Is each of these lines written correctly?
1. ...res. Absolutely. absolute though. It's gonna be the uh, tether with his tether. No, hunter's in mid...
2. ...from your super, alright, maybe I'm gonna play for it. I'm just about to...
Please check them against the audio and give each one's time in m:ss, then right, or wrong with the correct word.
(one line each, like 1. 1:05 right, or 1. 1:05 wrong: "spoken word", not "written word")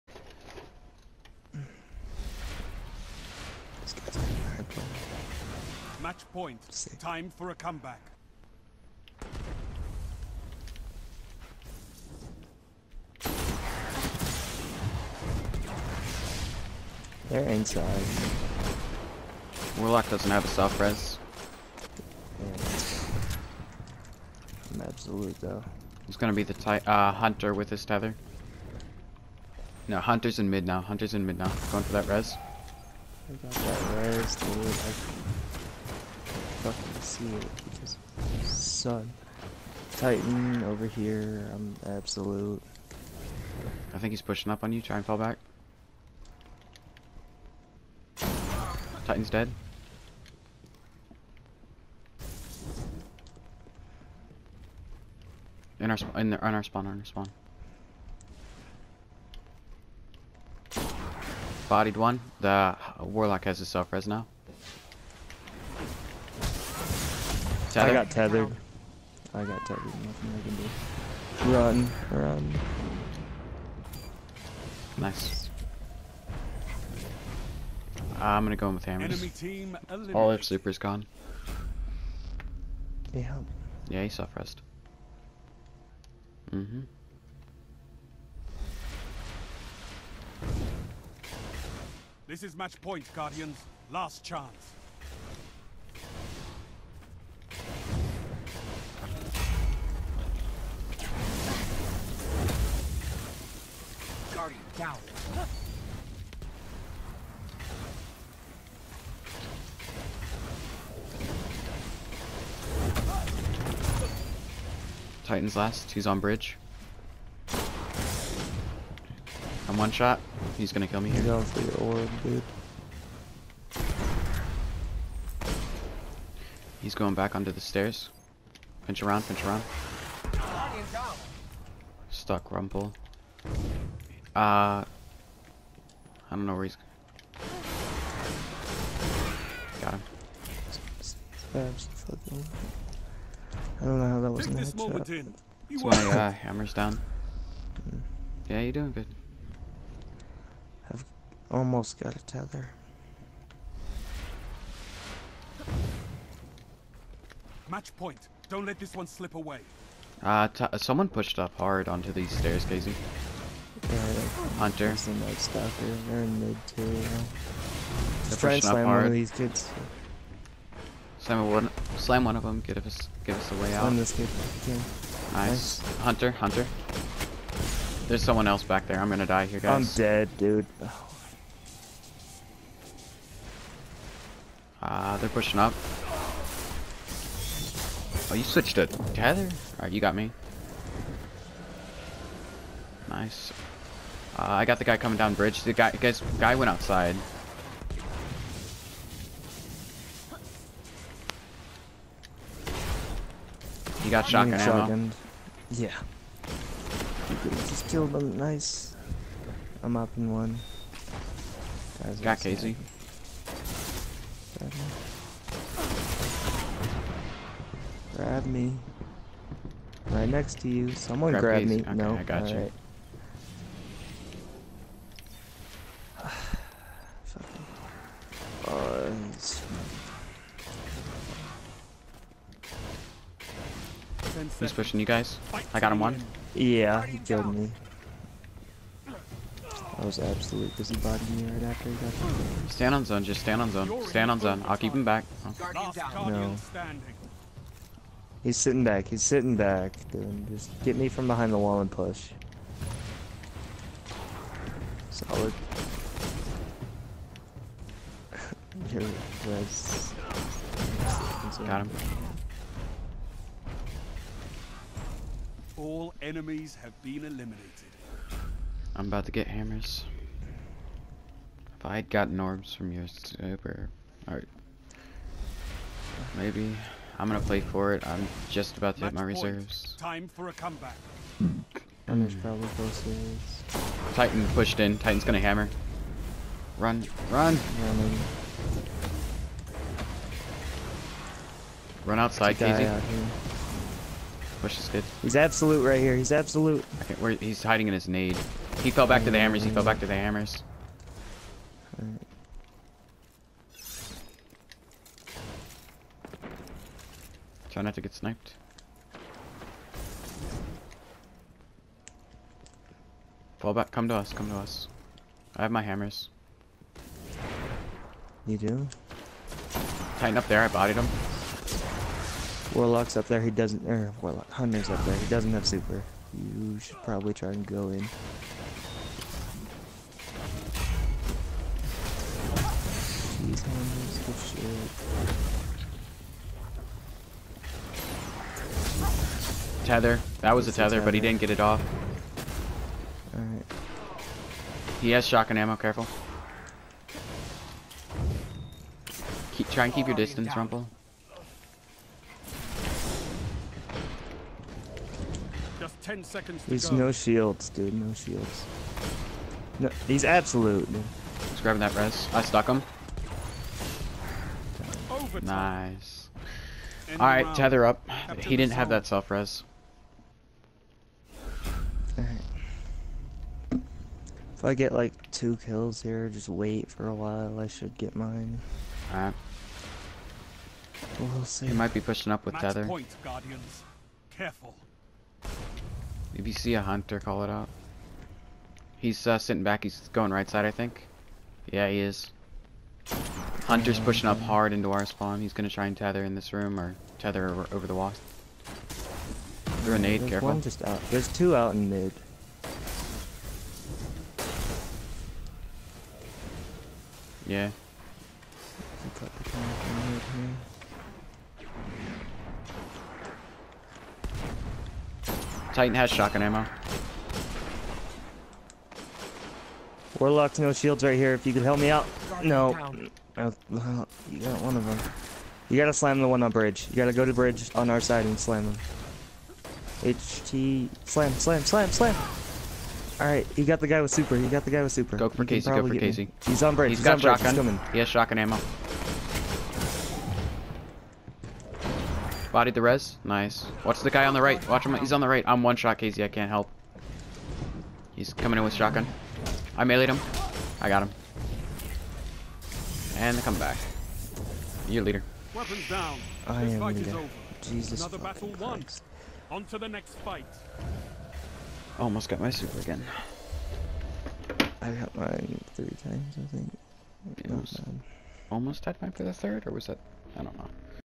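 1. 0:20 wrong: "hunter", not "tether"
2. 4:32 right.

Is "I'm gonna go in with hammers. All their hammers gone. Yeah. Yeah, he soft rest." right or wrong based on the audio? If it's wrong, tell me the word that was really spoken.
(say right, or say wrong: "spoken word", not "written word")
wrong: "supers", not "hammers".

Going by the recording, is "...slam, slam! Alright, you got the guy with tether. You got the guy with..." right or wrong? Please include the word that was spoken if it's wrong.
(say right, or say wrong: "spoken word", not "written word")
wrong: "super", not "tether".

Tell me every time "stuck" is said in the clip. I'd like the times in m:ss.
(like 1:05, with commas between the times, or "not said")
2:12, 6:02.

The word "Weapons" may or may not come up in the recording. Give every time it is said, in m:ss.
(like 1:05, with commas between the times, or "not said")
7:35.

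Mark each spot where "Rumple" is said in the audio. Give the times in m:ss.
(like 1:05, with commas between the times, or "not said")
2:12, 5:50.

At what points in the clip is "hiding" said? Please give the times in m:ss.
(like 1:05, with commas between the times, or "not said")
4:57.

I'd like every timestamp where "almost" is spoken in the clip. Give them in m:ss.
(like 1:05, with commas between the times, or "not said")
2:31, 7:41, 7:48.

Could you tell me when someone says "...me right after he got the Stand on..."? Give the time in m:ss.
4:01.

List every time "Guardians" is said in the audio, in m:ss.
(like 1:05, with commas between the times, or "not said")
1:33, 1:44, 6:23.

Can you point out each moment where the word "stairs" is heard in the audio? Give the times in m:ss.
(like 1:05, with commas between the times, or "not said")
2:07, 2:42.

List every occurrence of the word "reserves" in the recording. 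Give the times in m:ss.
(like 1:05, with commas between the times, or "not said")
4:39.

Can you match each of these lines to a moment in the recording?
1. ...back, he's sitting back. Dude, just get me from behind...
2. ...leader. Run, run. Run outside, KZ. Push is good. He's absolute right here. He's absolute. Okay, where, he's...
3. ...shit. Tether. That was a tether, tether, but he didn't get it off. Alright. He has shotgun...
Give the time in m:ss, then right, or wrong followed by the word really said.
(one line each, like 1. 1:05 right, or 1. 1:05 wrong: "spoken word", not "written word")
1. 4:08 right
2. 4:45 wrong: "hammer", not "leader"
3. 5:39 right.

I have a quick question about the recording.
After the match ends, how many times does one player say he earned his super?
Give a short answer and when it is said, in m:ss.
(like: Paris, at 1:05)
3 times, at 7:45.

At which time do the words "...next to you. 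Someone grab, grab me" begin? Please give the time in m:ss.
3:40.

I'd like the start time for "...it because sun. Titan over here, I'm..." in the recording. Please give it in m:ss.
0:37.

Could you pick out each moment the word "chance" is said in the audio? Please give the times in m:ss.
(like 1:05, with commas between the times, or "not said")
1:34.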